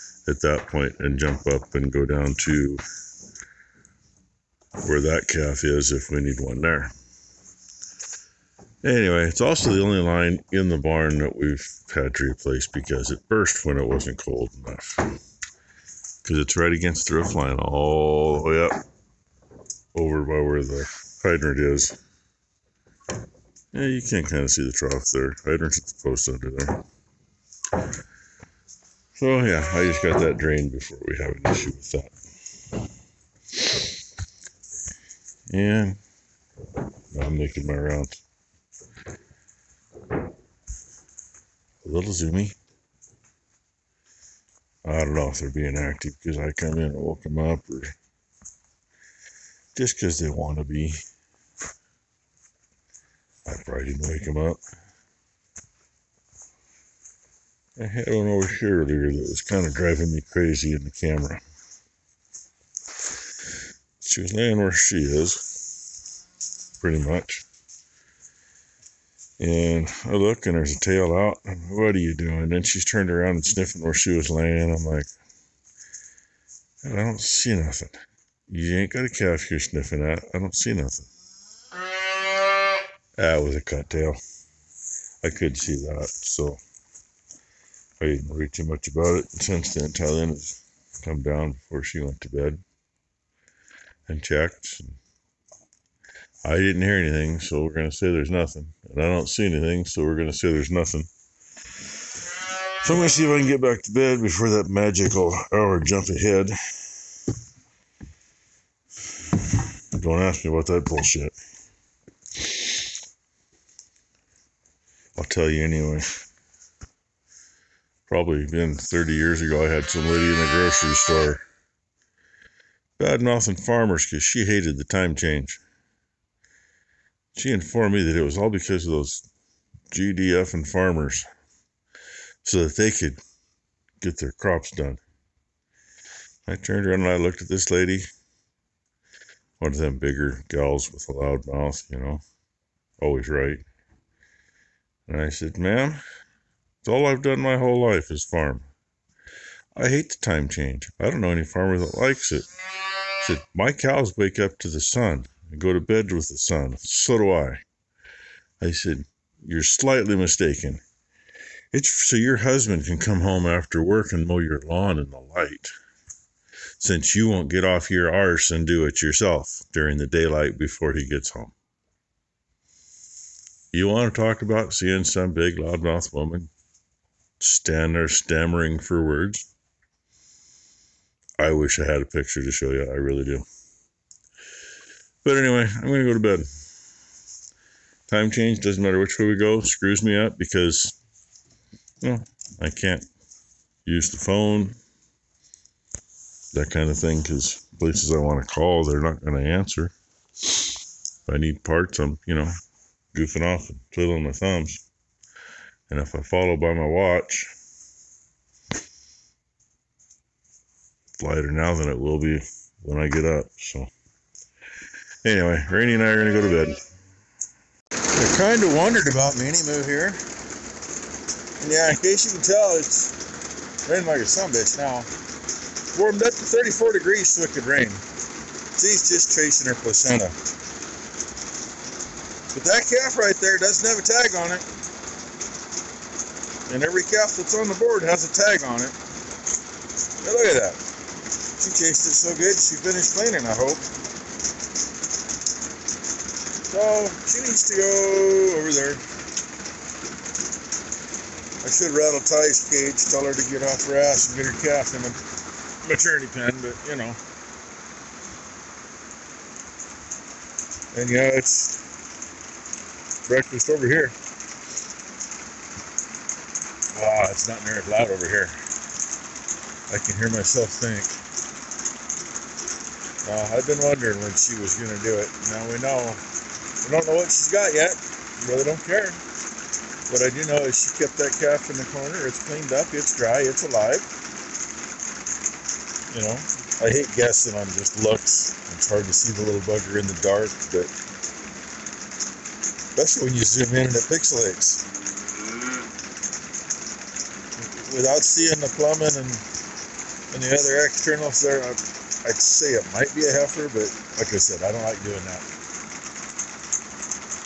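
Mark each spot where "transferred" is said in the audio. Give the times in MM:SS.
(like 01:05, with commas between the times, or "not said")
not said.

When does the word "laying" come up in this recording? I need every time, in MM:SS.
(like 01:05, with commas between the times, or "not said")
01:04, 01:14.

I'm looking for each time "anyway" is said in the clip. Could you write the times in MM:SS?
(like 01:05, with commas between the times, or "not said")
00:08, 01:55, 03:05, 03:35.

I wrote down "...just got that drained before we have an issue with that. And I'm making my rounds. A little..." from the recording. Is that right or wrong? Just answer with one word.
right.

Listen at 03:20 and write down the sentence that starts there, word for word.
If I need parts, I'm, you know, goofing off and twiddling my thumbs.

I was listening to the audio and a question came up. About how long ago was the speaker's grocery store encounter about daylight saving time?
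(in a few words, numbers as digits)
30 years.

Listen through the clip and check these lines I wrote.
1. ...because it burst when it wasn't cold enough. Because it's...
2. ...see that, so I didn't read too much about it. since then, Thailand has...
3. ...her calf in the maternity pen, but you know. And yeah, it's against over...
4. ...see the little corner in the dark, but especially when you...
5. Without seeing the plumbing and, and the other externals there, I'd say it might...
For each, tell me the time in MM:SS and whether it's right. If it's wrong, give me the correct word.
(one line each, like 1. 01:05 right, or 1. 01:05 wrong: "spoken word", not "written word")
1. 00:12 right
2. 01:25 right
3. 04:14 wrong: "breakfast", not "against"
4. 04:49 wrong: "bugger", not "corner"
5. 04:57 right.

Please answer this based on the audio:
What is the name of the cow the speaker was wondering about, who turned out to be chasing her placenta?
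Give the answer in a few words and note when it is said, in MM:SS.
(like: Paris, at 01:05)
Minnie Moo, at 03:39.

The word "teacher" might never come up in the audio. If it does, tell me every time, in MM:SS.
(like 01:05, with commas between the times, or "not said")
not said.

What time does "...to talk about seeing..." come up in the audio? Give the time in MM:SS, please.
02:54.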